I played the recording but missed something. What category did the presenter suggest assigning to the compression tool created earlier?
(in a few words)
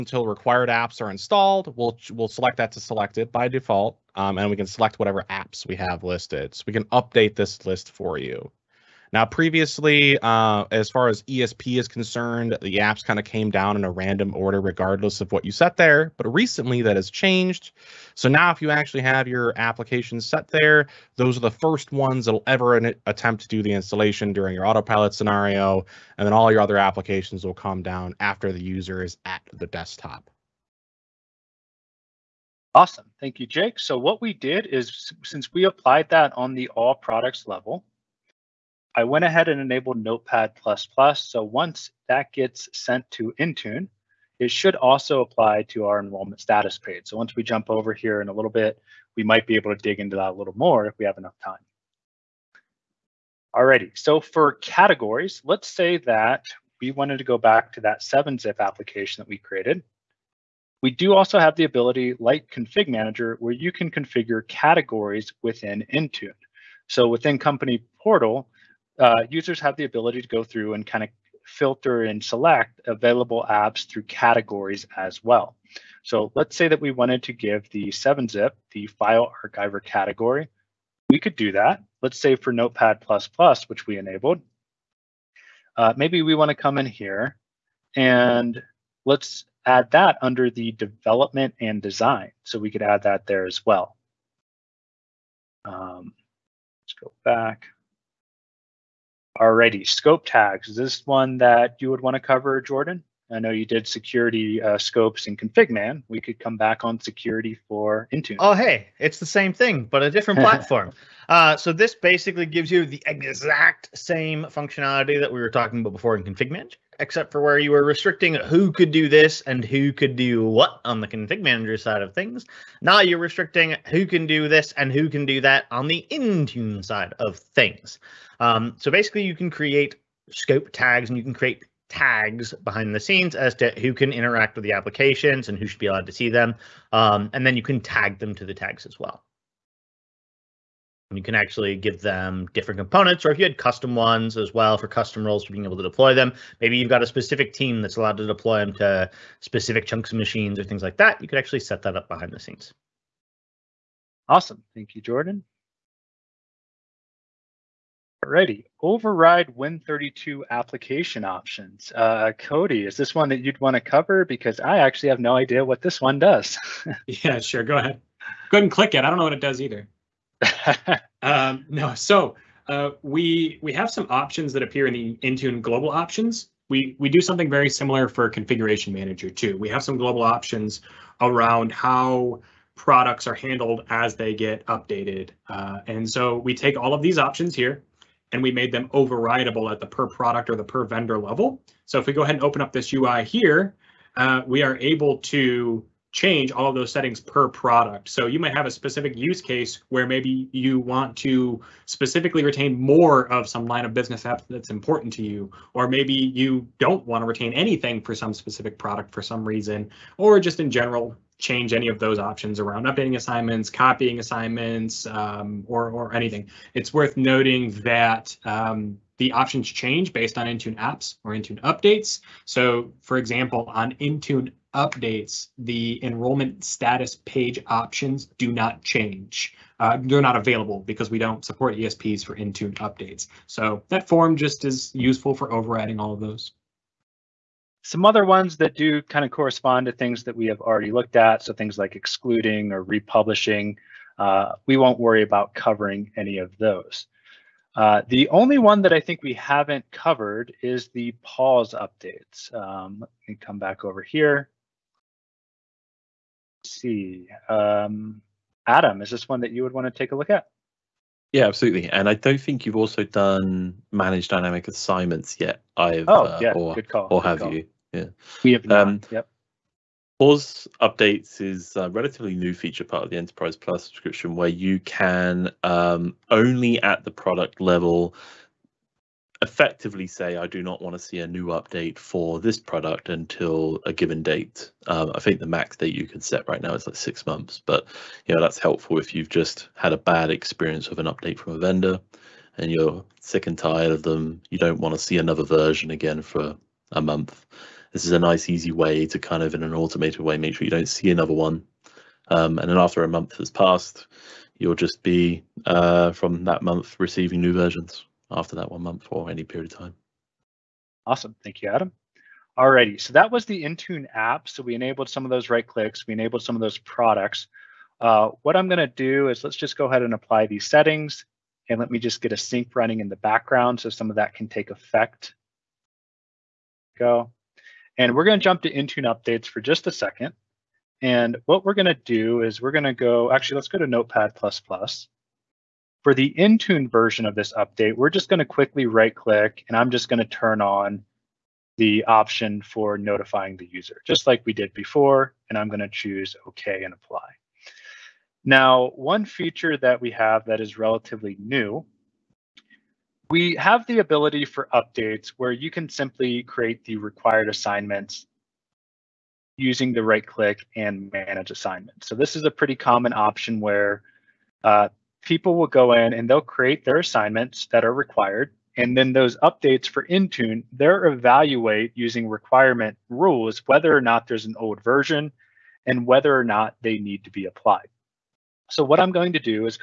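File archiver.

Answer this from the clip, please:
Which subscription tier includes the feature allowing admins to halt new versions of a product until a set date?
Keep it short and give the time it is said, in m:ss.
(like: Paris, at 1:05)
Enterprise Plus, at 4:33.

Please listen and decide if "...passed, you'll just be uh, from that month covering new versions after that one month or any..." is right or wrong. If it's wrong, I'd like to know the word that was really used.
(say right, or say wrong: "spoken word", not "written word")
wrong: "receiving", not "covering".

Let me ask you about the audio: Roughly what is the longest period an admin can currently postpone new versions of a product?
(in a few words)
6 months.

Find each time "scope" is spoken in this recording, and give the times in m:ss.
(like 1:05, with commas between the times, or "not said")
1:39, 1:44, 2:10.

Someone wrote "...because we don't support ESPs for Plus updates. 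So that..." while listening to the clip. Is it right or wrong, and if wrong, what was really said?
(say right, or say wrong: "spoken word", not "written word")
wrong: "Intune", not "Plus".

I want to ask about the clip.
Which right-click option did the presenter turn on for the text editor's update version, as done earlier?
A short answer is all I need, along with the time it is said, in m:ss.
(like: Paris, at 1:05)
Notifying the user, at 5:42.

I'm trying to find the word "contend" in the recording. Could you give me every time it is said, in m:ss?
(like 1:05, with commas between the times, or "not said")
not said.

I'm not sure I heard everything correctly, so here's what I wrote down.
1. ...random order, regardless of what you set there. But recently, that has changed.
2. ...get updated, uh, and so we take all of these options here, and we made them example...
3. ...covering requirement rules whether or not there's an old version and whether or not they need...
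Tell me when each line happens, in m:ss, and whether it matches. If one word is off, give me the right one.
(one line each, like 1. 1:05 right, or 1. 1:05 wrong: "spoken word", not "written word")
1. 0:13 right
2. 3:04 wrong: "overrideable", not "example"
3. 6:11 wrong: "using", not "covering".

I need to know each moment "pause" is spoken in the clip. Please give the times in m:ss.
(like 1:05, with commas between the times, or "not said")
4:11, 4:30.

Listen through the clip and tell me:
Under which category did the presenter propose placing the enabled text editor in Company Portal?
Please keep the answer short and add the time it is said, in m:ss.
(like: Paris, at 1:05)
Development and design, at 1:30.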